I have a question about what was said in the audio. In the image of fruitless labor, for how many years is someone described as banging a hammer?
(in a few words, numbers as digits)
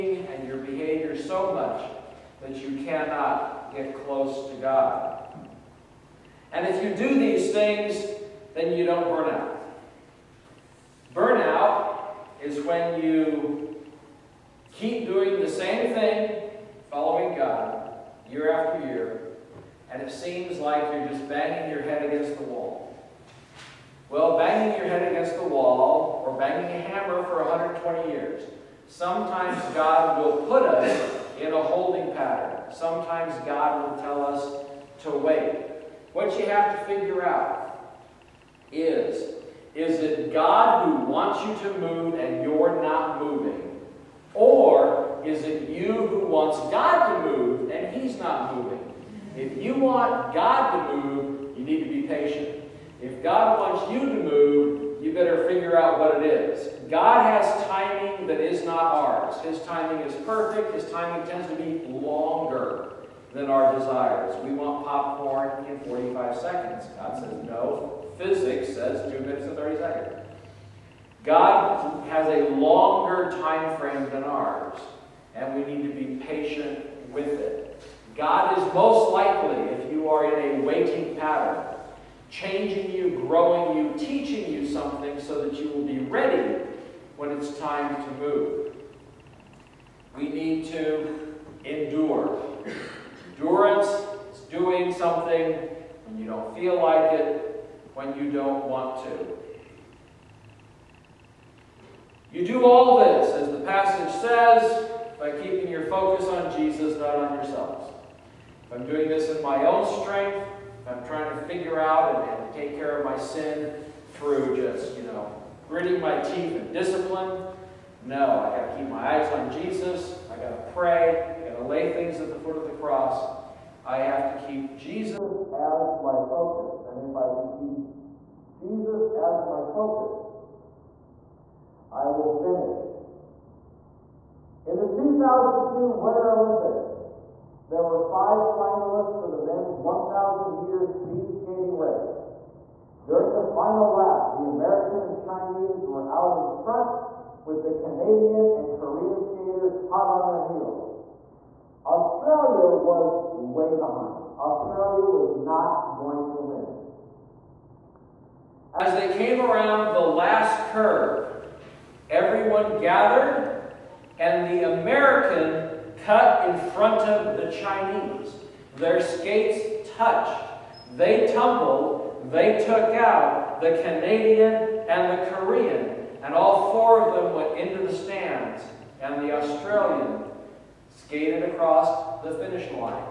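120.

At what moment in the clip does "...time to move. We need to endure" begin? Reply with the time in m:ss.
1:27.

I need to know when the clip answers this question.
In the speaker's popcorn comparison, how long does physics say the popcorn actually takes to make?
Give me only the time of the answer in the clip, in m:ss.
1:09.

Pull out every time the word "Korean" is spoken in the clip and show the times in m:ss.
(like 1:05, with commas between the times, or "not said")
2:28, 2:55.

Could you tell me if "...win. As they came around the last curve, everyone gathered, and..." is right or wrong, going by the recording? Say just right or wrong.
right.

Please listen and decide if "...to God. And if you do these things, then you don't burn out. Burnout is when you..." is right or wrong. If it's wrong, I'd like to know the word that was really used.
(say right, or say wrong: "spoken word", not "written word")
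right.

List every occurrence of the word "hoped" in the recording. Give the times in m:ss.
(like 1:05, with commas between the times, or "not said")
not said.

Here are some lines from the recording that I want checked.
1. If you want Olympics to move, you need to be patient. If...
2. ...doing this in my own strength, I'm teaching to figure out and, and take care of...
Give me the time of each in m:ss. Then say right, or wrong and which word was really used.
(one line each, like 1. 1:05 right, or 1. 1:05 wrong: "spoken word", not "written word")
1. 0:49 wrong: "God", not "Olympics"
2. 1:48 wrong: "trying", not "teaching".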